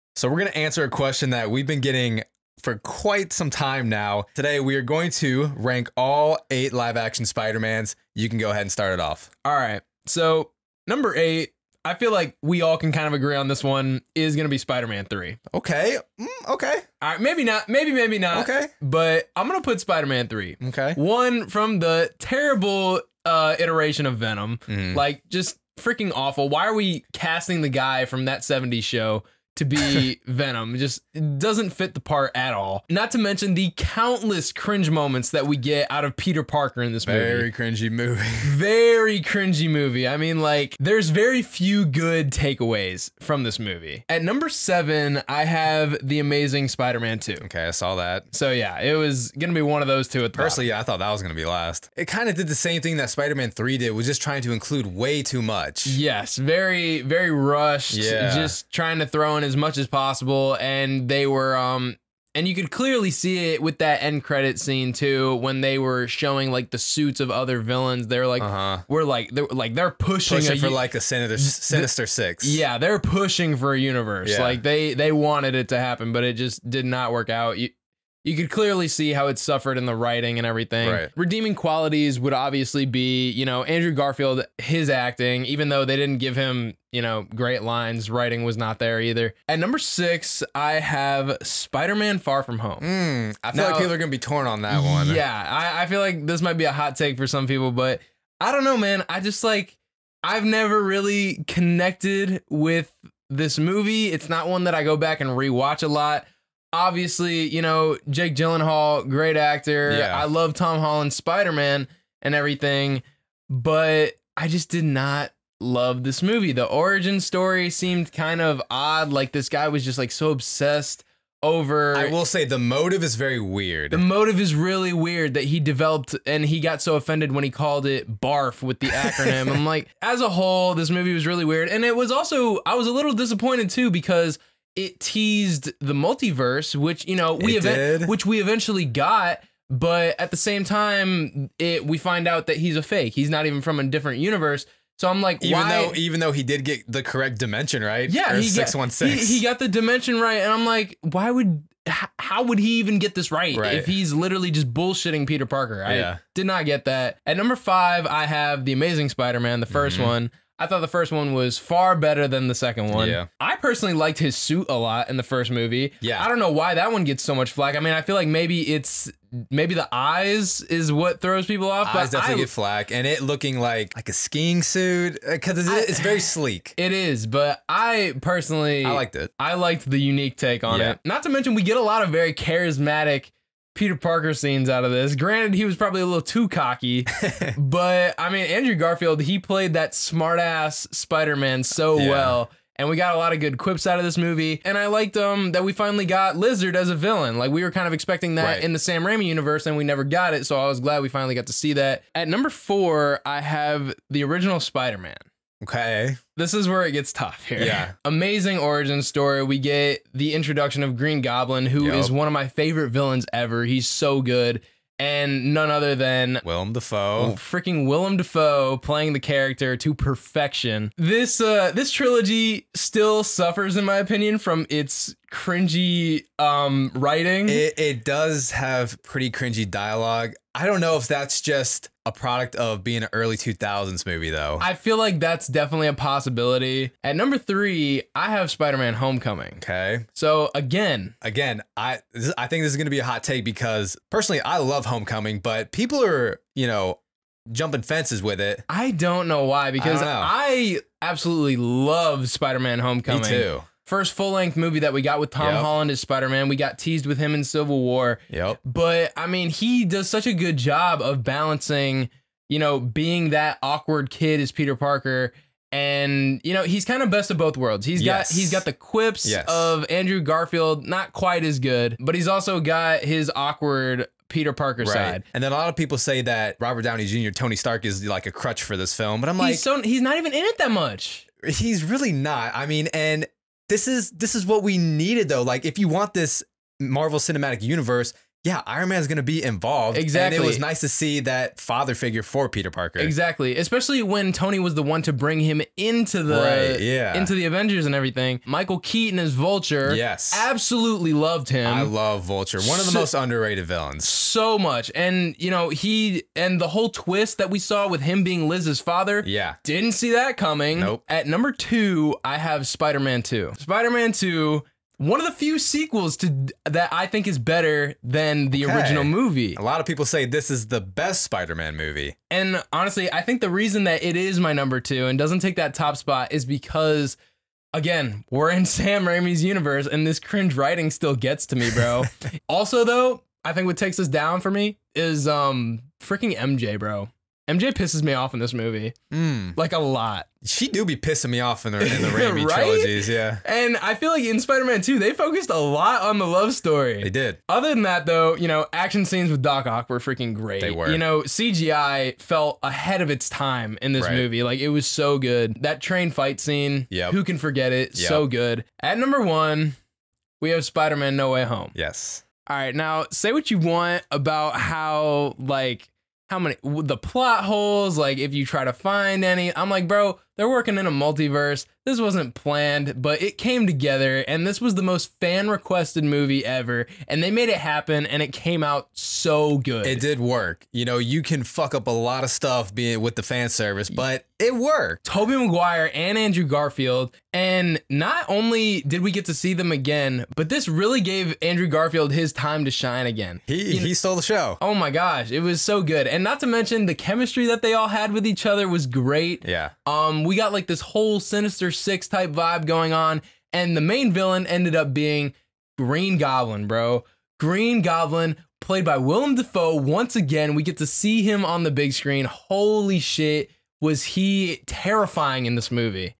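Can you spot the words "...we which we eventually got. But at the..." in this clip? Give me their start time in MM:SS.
02:17.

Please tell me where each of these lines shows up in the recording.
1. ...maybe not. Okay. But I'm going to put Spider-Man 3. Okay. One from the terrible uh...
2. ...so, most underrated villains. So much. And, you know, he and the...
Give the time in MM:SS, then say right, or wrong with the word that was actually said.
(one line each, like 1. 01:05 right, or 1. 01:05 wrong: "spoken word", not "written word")
1. 00:17 right
2. 05:02 right.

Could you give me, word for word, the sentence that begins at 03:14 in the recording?
And I liked um, that we finally got Lizard as a villain.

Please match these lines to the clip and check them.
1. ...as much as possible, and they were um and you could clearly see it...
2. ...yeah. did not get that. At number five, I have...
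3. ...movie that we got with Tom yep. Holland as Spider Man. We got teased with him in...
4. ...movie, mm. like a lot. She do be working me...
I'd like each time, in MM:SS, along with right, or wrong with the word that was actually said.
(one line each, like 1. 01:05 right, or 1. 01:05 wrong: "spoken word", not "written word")
1. 00:59 right
2. 02:35 right
3. 04:14 right
4. 05:38 wrong: "pissing", not "working".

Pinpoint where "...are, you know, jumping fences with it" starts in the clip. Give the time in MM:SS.
04:06.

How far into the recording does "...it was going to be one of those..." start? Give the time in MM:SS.
00:48.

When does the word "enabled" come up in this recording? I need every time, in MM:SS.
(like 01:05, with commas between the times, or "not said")
not said.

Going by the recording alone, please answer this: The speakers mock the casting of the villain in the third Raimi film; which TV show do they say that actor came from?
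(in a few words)
That 70s Show.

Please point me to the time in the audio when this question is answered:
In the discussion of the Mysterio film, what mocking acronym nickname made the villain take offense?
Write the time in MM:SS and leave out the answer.
02:08.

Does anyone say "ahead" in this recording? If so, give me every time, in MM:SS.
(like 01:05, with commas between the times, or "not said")
00:08, 05:52.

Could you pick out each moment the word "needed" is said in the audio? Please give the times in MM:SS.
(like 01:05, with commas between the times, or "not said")
04:44.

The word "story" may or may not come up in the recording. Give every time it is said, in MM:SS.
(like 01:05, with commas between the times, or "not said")
01:57, 03:29, 05:46.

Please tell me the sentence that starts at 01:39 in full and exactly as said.
I just like, I've never really connected with this movie.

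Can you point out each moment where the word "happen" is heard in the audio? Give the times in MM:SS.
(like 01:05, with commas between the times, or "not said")
01:15, 06:17.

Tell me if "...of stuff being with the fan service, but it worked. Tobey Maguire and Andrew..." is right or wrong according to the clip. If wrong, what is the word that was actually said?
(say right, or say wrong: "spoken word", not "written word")
right.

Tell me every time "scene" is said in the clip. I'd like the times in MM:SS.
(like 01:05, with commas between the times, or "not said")
01:04, 03:04, 05:49, 05:56.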